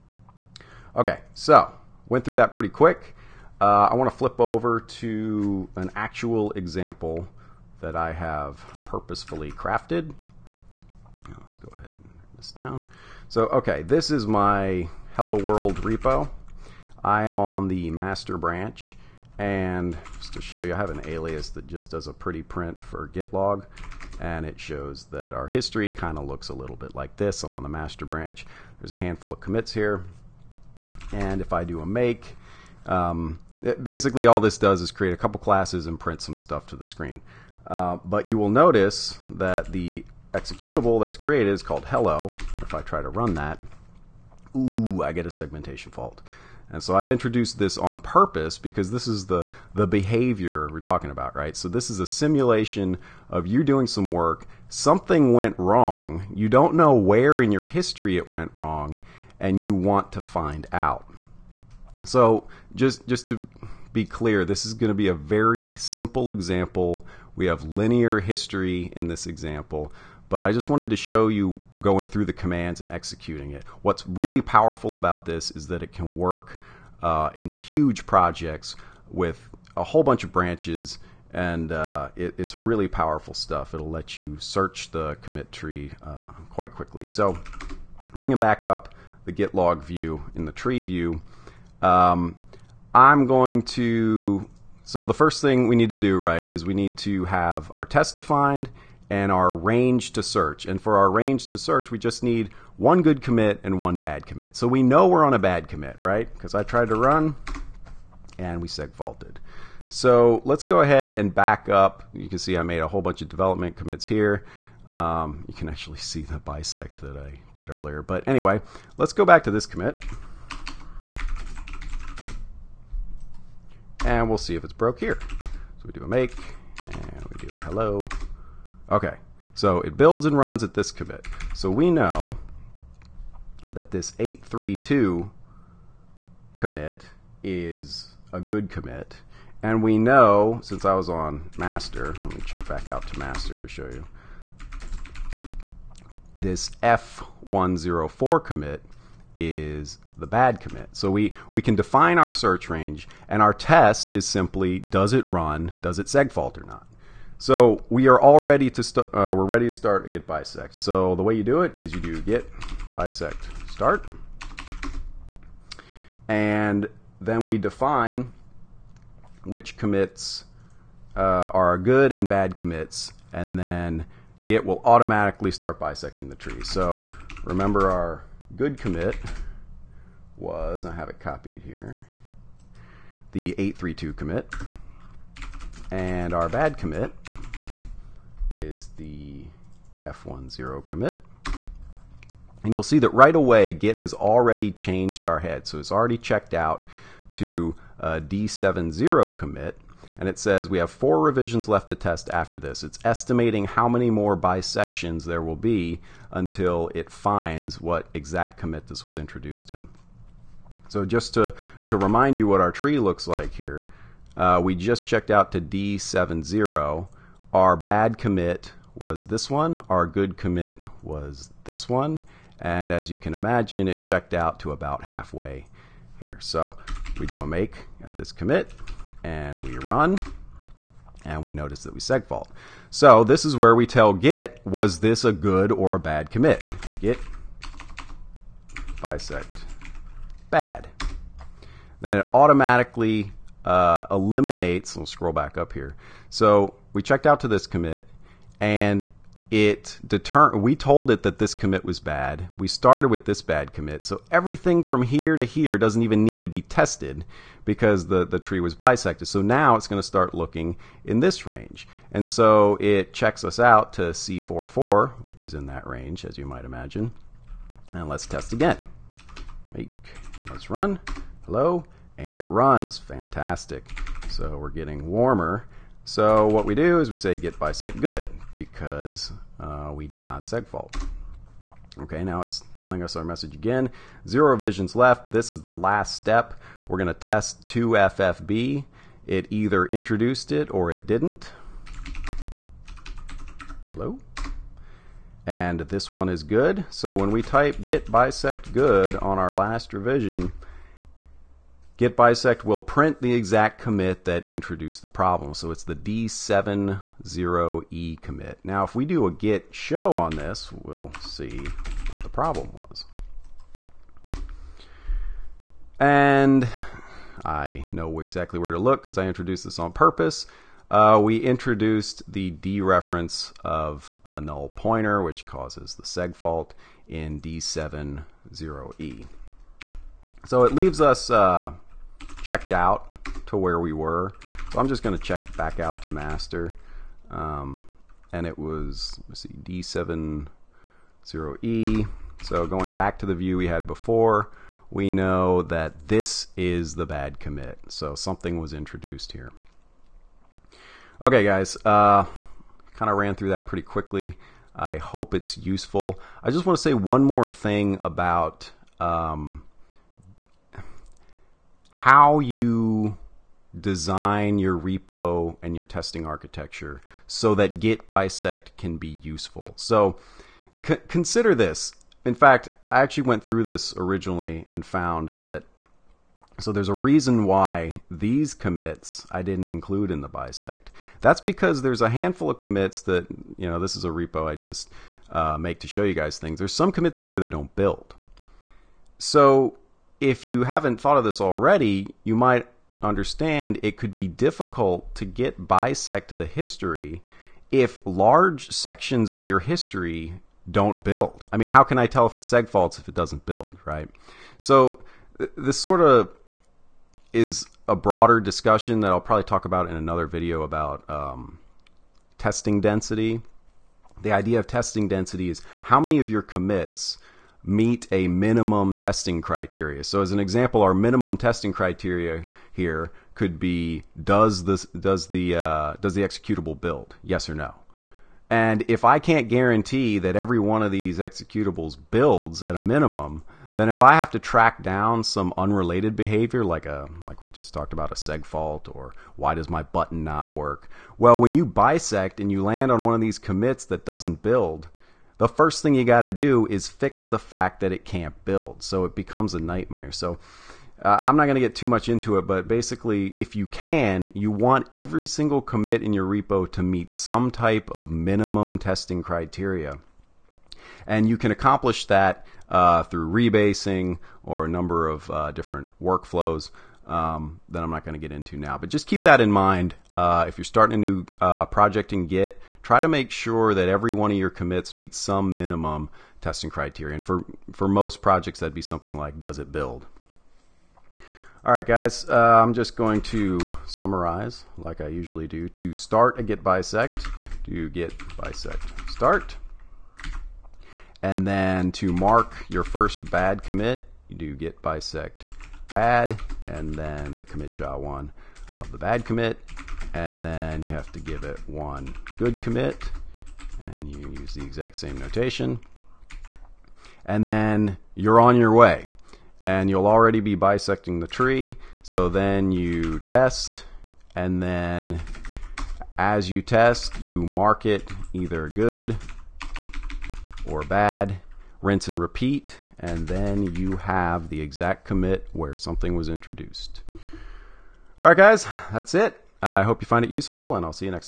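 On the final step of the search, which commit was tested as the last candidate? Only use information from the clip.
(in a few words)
2FFB.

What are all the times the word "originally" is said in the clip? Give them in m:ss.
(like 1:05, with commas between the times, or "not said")
6:13.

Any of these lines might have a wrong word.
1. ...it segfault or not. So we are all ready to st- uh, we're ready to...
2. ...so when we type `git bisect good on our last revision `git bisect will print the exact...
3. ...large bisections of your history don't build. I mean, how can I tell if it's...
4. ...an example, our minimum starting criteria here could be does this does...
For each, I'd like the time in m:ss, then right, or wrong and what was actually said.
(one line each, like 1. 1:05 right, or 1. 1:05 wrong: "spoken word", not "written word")
1. 2:35 right
2. 4:56 right
3. 6:38 wrong: "sections", not "bisections"
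4. 7:00 wrong: "testing", not "starting".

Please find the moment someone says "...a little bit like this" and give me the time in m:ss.
0:26.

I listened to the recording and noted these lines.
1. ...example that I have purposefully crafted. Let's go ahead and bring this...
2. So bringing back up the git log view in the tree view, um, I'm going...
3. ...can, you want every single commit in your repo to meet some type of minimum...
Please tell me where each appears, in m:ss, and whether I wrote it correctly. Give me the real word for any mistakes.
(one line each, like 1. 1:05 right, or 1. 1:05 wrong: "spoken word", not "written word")
1. 0:06 right
2. 1:27 right
3. 7:33 right.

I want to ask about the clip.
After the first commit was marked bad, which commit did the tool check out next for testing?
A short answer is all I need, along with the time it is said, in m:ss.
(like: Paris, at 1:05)
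C44, at 4:24.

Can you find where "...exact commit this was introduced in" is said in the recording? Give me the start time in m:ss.
3:28.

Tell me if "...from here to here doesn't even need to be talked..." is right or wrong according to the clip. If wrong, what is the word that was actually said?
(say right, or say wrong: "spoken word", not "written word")
wrong: "tested", not "talked".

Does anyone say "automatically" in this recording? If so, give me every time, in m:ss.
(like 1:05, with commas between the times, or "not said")
2:54, 4:02.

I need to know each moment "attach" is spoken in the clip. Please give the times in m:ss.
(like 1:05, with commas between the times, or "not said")
not said.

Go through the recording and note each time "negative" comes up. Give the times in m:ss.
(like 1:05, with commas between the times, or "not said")
not said.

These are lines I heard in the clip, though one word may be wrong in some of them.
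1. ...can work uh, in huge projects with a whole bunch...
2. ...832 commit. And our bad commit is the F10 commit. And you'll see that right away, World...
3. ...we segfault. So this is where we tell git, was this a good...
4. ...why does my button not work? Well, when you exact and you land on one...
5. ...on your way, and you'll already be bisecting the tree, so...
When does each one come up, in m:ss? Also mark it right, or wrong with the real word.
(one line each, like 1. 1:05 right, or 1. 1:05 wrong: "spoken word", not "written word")
1. 1:15 right
2. 3:03 wrong: "Git", not "World"
3. 3:51 right
4. 7:19 wrong: "bisect", not "exact"
5. 8:28 right.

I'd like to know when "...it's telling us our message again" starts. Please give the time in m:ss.
4:42.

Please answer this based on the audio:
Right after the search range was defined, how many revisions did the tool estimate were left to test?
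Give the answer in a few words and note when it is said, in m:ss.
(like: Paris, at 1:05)
4, at 3:20.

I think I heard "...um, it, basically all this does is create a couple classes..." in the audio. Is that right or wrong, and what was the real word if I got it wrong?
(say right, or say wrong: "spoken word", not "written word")
right.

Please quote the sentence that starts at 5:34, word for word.
So I'm just going to check back out to master.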